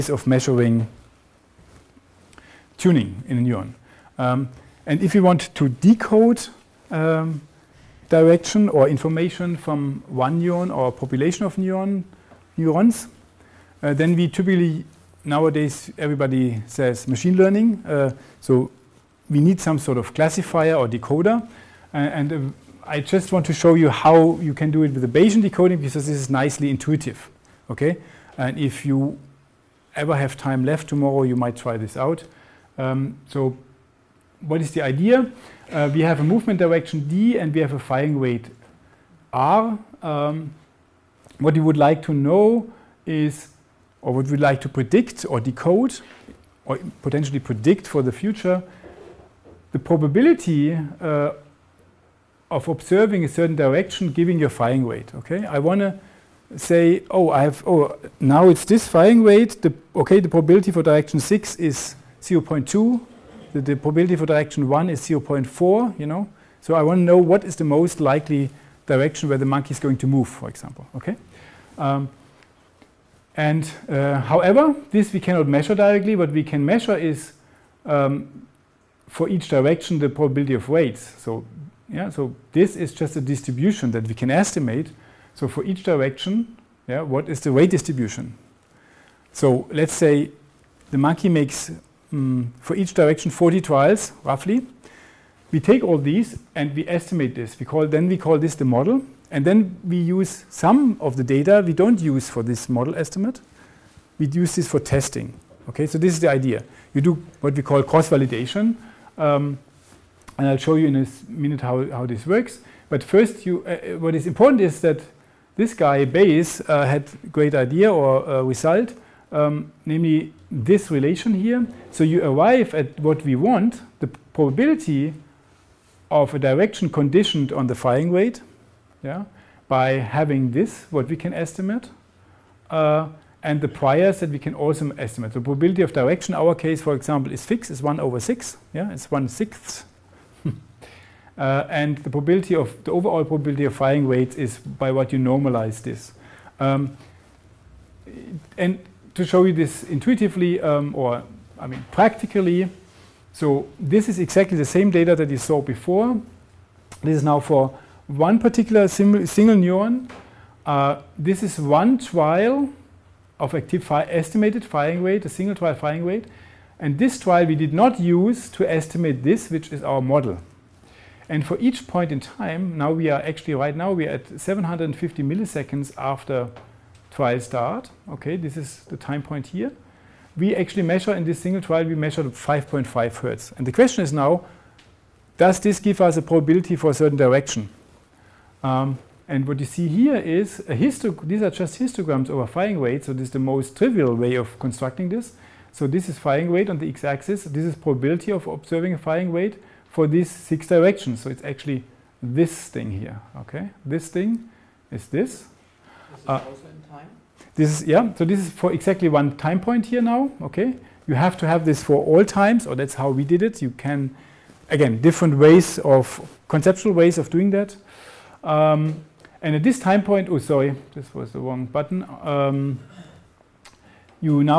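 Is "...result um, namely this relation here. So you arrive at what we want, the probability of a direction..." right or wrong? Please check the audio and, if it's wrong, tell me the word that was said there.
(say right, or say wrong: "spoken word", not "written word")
right.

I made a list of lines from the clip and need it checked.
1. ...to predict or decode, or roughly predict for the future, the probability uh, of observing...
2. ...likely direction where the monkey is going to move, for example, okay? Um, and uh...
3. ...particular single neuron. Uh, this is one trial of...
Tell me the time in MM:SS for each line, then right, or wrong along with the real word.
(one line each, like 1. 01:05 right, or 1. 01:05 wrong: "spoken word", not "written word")
1. 00:44 wrong: "potentially", not "roughly"
2. 01:08 right
3. 02:38 right.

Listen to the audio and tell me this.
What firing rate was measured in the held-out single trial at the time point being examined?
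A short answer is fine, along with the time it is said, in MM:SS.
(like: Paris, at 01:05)
5.5 hertz, at 03:02.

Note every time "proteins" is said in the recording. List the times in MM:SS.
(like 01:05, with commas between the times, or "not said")
not said.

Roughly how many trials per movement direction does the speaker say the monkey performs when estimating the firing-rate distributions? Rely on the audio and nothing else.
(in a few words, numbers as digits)
40.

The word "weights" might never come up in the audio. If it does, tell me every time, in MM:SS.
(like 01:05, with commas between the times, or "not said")
01:20, 01:27.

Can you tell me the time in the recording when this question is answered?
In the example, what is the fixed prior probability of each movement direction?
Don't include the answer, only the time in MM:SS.
02:17.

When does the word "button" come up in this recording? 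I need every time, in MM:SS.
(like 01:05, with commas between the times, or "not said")
03:41.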